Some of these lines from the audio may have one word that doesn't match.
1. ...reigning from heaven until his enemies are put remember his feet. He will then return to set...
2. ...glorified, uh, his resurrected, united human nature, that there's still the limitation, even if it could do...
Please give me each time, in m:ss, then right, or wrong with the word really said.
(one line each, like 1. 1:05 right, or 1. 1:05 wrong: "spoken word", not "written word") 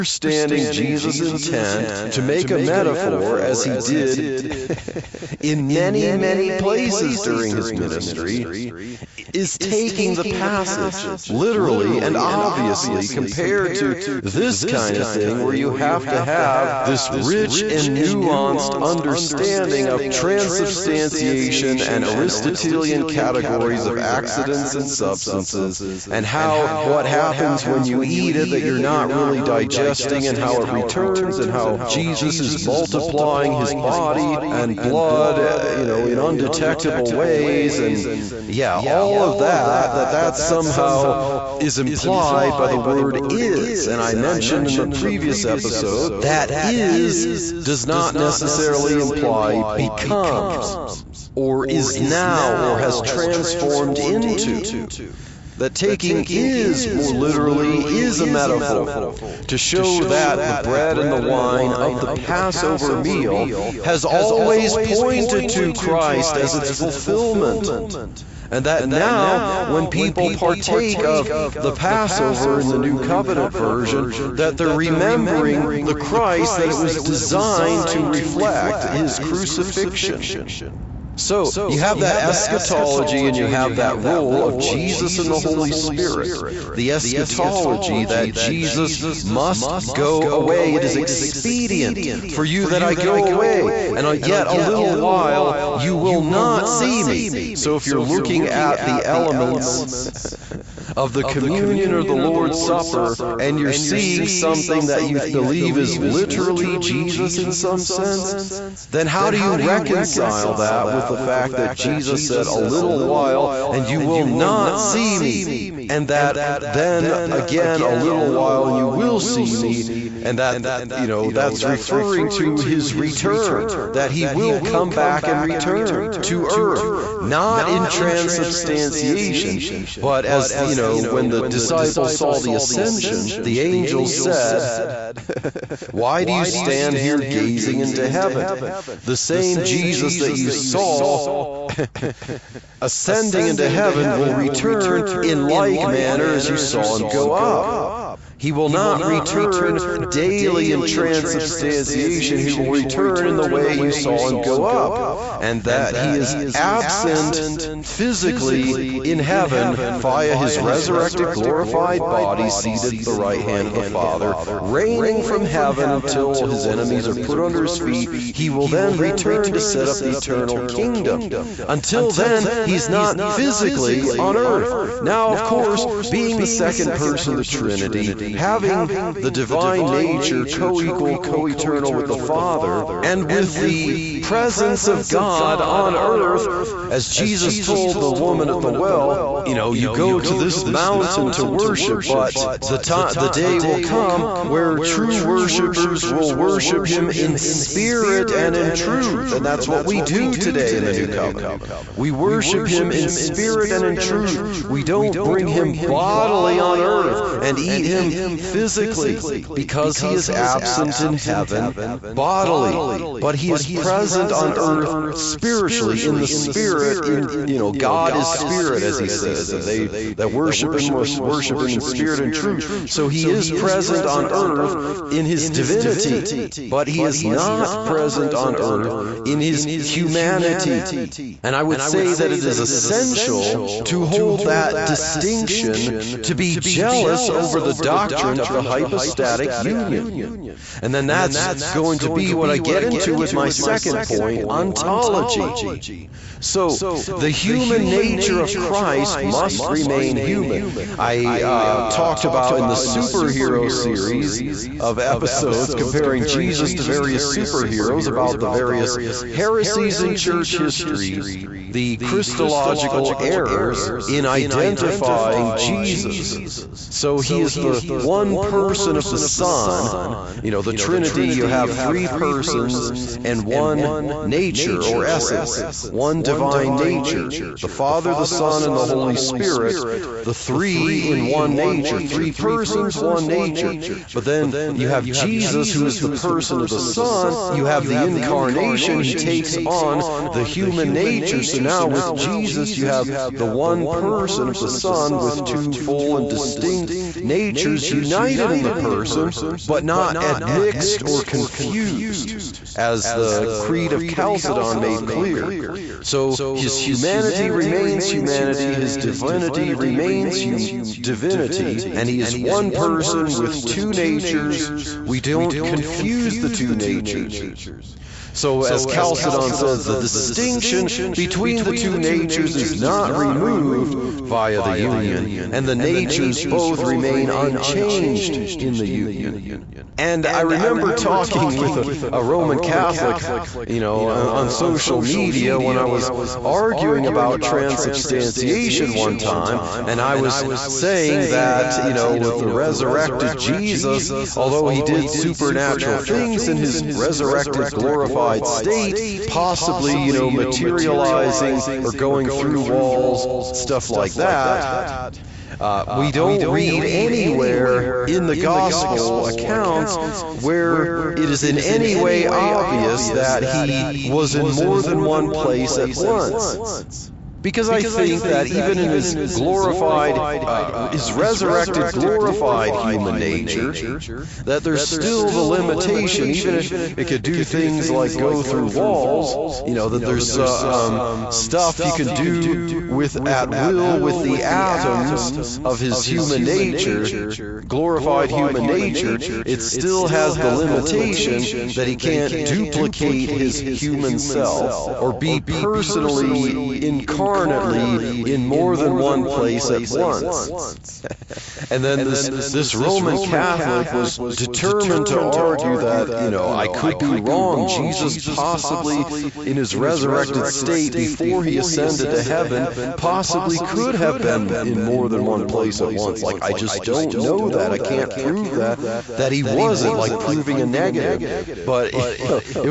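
1. 2:44 wrong: "under", not "remember"
2. 6:09 wrong: "glorified", not "united".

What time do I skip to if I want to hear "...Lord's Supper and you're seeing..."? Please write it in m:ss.
1:42.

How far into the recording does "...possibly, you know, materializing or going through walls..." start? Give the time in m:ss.
5:49.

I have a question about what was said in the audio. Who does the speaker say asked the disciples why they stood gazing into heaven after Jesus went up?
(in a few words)
The angels.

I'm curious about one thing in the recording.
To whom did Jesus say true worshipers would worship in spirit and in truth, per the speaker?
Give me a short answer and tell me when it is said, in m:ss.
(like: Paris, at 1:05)
The woman at the well, at 3:08.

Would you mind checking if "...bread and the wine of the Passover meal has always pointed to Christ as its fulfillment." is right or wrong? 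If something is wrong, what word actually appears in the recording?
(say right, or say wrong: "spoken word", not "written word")
right.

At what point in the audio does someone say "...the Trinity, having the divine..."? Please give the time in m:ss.
2:57.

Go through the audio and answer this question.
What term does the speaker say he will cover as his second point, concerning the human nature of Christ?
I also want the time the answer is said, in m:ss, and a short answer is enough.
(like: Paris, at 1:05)
Ontology, at 4:04.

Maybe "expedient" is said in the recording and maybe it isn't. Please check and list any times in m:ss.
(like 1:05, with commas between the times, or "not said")
1:30.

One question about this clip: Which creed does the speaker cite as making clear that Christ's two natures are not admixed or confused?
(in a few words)
Creed of Chalcedon.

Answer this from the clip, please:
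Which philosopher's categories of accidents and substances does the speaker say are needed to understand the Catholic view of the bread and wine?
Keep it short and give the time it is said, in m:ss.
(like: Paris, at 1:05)
Aristotelian, at 0:22.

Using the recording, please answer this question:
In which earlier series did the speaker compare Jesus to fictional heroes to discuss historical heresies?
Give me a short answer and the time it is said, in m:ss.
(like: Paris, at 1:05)
The superhero series, at 4:12.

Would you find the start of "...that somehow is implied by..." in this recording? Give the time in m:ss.
0:40.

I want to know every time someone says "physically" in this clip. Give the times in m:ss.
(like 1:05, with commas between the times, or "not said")
2:37, 2:53, 3:28.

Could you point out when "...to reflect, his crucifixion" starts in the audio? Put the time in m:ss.
1:17.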